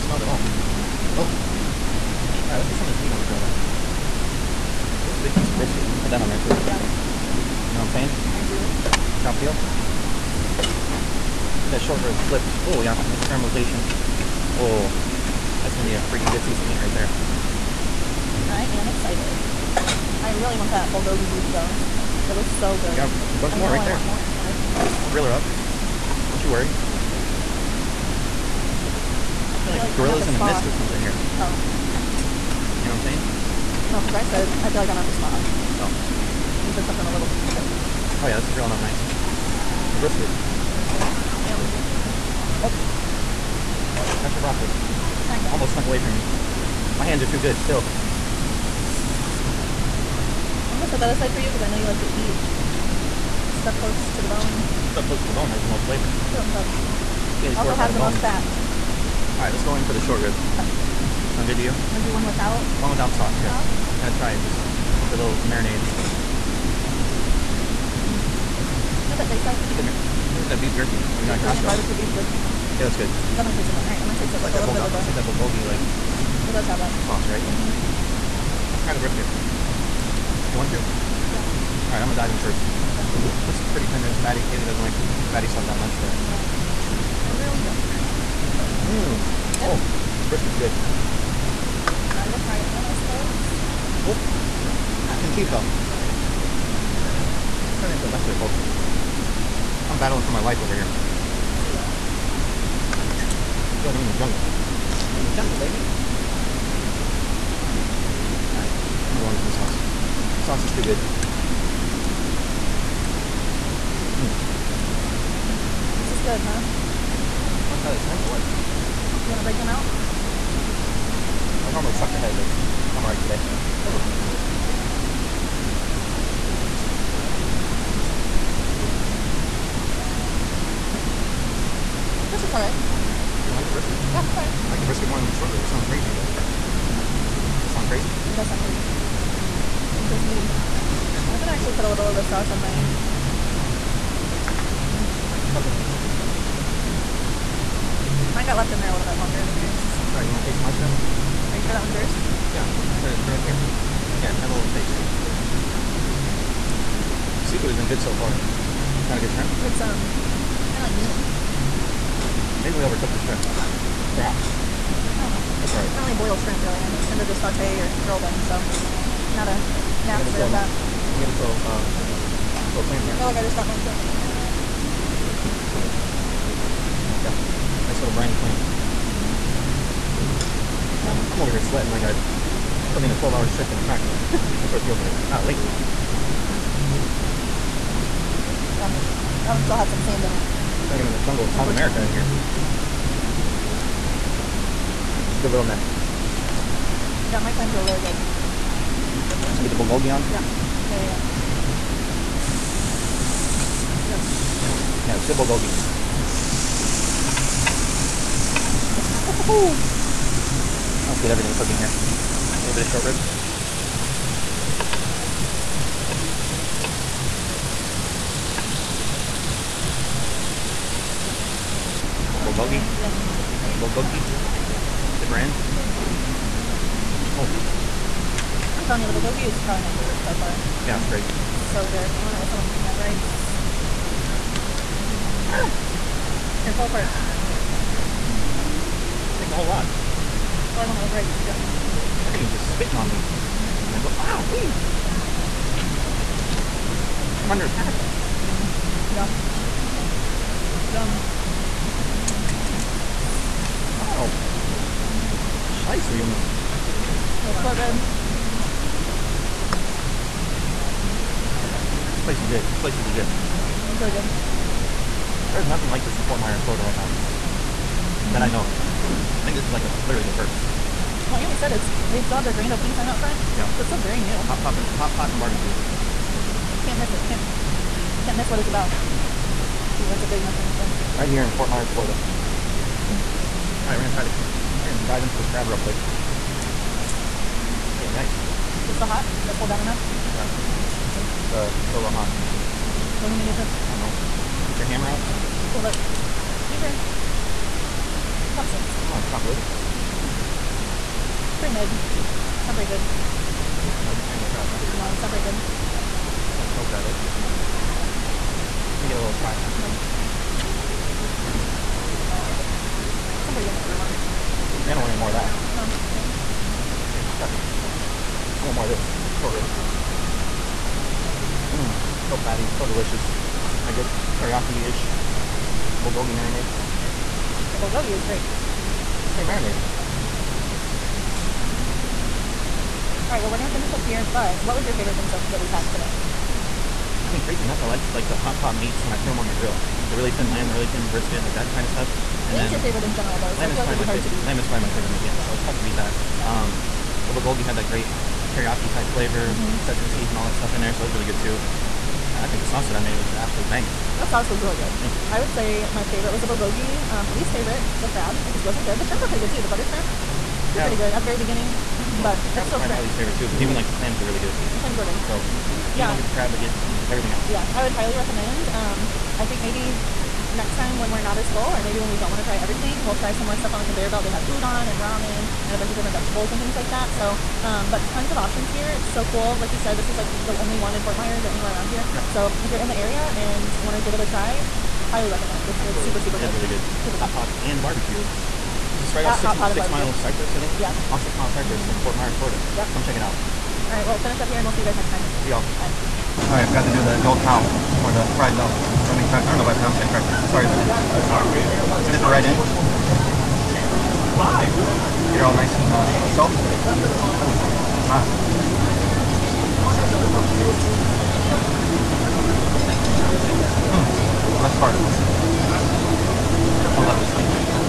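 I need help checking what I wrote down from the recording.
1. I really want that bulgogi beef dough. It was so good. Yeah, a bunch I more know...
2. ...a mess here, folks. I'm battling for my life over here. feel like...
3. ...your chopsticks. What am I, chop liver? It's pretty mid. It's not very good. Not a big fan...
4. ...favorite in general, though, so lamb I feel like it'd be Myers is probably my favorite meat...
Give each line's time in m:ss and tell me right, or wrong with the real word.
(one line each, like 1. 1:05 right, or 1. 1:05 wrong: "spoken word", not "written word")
1. 0:20 wrong: "though", not "dough"
2. 1:38 right
3. 4:56 right
4. 5:42 wrong: "Lamb", not "Myers".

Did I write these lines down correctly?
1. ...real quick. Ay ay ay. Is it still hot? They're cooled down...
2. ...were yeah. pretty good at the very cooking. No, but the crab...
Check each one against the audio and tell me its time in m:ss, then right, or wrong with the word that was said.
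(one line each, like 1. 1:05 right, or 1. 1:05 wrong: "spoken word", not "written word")
1. 4:45 right
2. 6:00 wrong: "beginning", not "cooking".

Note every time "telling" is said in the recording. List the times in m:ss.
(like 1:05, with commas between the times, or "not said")
3:48.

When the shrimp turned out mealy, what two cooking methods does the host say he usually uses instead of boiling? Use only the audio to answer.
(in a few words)
saute or grill.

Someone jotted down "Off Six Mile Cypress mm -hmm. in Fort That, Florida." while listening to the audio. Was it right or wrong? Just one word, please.
wrong.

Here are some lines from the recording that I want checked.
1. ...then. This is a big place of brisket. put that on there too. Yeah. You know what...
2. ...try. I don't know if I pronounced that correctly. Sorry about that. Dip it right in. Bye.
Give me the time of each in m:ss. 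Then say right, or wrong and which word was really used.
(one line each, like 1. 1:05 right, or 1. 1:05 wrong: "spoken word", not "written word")
1. 0:03 wrong: "piece", not "place"
2. 6:39 right.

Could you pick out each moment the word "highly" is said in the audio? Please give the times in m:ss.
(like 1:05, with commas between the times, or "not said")
6:07, 6:25.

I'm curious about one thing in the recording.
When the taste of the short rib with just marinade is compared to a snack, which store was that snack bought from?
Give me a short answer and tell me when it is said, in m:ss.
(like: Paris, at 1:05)
Costco, at 1:11.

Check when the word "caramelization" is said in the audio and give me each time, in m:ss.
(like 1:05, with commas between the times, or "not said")
0:13.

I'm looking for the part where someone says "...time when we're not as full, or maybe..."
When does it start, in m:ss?
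6:10.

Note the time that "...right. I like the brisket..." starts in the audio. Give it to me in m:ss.
2:14.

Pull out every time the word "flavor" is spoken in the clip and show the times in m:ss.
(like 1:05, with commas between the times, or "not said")
0:55, 5:49.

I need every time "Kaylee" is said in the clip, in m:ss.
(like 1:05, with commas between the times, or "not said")
0:57, 1:24.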